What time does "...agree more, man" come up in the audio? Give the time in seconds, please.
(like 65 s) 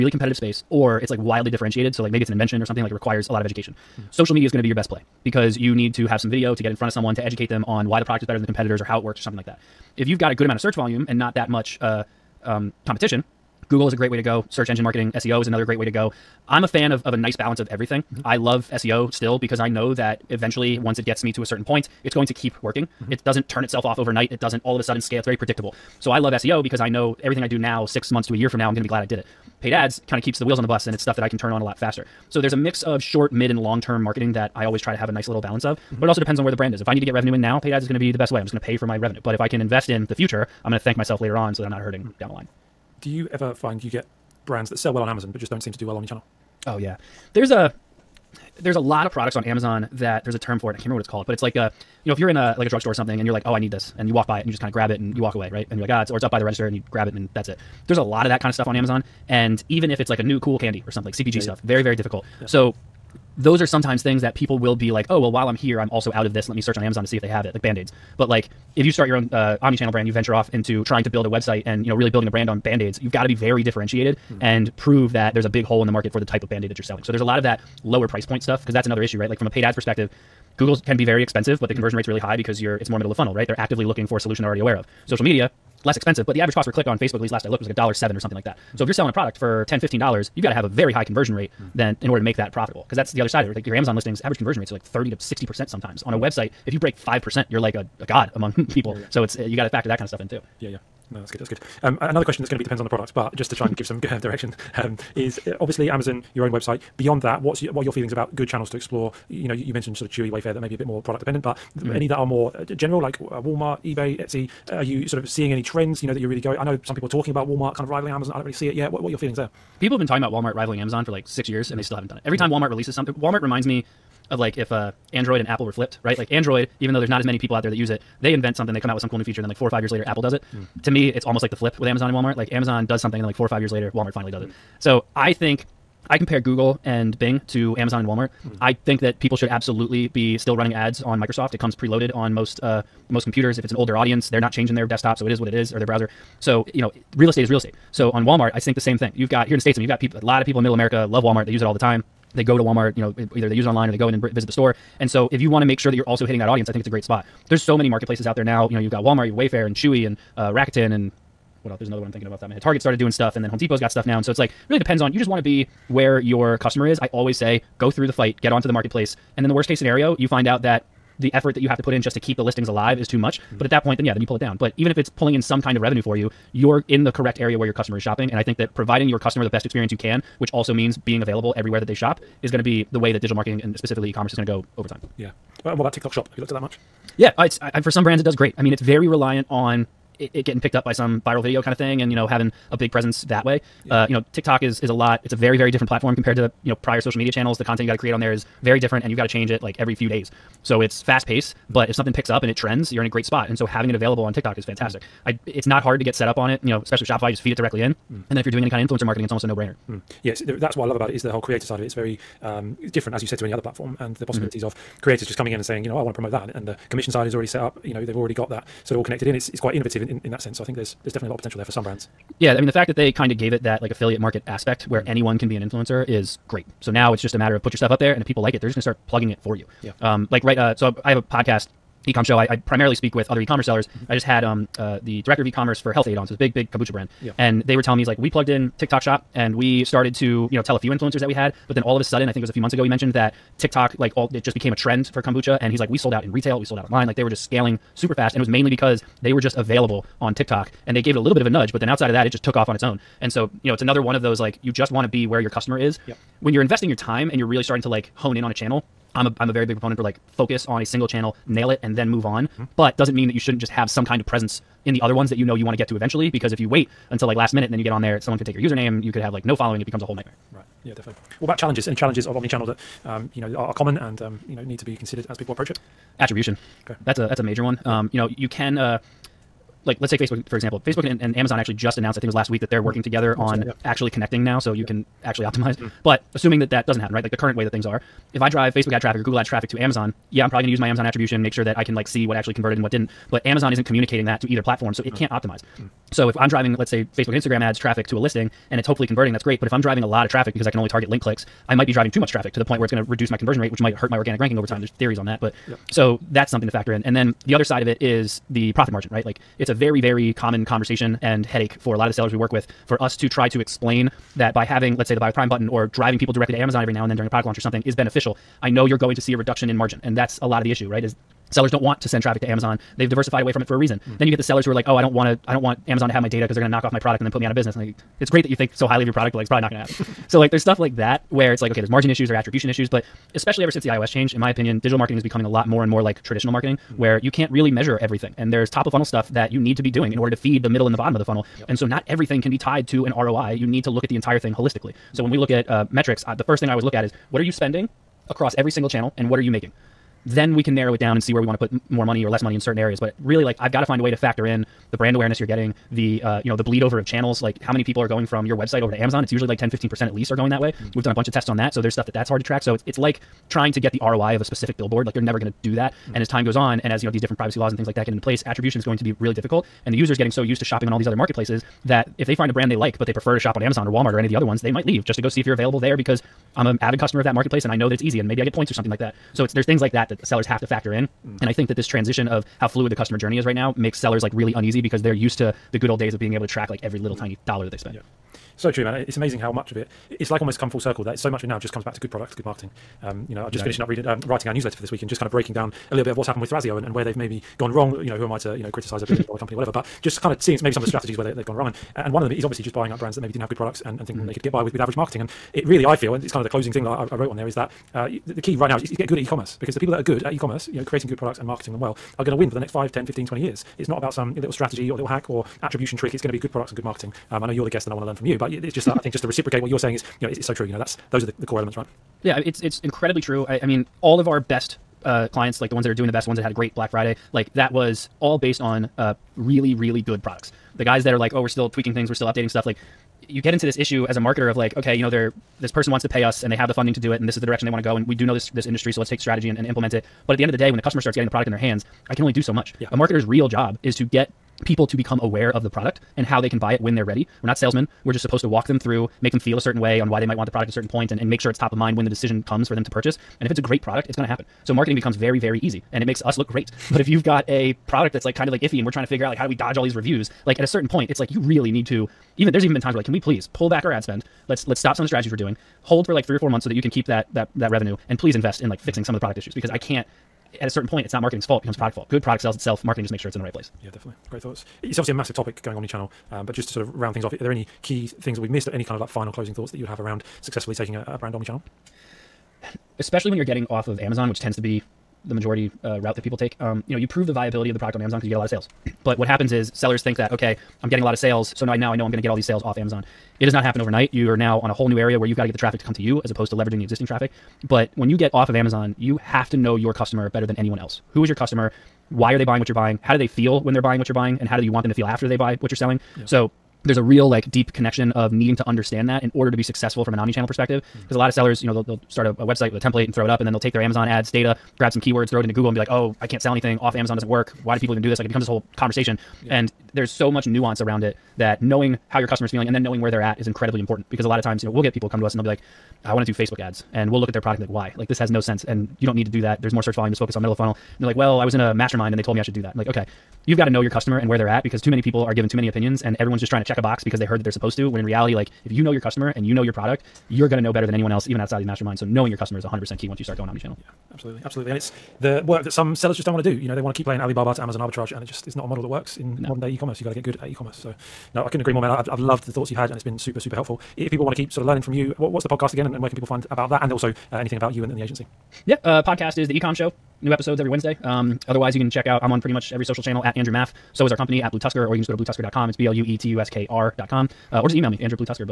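551 s.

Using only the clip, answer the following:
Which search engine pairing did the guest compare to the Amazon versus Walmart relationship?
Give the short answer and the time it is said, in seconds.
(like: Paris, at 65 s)
Google and Bing, at 136 s.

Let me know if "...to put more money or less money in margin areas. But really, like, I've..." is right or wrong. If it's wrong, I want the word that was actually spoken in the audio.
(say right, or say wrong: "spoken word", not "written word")
wrong: "certain", not "margin".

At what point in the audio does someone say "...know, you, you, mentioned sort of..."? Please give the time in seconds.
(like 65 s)
109 s.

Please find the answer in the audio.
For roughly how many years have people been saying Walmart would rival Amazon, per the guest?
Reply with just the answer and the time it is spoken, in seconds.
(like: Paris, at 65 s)
6, at 121 s.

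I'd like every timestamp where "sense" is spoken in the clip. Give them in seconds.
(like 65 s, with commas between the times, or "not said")
220 s, 528 s.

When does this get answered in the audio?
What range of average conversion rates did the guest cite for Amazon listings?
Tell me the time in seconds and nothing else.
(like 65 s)
94 s.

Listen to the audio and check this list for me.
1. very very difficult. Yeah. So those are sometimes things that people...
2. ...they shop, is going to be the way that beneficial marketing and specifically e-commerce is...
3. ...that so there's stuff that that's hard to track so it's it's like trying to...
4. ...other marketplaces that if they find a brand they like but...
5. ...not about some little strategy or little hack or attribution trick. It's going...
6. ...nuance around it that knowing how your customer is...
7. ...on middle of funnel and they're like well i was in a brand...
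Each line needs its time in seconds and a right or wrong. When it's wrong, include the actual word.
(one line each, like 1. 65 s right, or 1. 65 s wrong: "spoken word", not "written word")
1. 61 s right
2. 181 s wrong: "digital", not "beneficial"
3. 361 s right
4. 371 s right
5. 413 s right
6. 520 s right
7. 530 s wrong: "mastermind", not "brand".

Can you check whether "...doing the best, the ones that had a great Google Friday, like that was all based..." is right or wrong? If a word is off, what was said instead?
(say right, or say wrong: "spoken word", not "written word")
wrong: "Black", not "Google".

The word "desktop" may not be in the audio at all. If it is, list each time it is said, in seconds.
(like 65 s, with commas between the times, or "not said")
144 s.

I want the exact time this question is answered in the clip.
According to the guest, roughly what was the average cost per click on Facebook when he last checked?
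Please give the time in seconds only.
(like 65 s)
87 s.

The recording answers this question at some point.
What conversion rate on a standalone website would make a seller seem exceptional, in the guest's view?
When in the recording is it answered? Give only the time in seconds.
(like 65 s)
96 s.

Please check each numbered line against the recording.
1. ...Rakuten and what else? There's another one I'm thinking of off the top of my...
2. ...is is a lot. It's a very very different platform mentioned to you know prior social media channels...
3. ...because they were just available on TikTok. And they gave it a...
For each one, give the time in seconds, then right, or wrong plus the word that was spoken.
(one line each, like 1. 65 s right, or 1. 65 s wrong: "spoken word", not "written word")
1. 160 s right
2. 194 s wrong: "compared", not "mentioned"
3. 248 s right.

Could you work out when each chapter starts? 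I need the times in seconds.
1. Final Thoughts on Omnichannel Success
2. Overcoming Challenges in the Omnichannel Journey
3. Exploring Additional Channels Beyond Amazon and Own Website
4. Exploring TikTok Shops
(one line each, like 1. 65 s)
1. 471 s
2. 268 s
3. 98 s
4. 183 s.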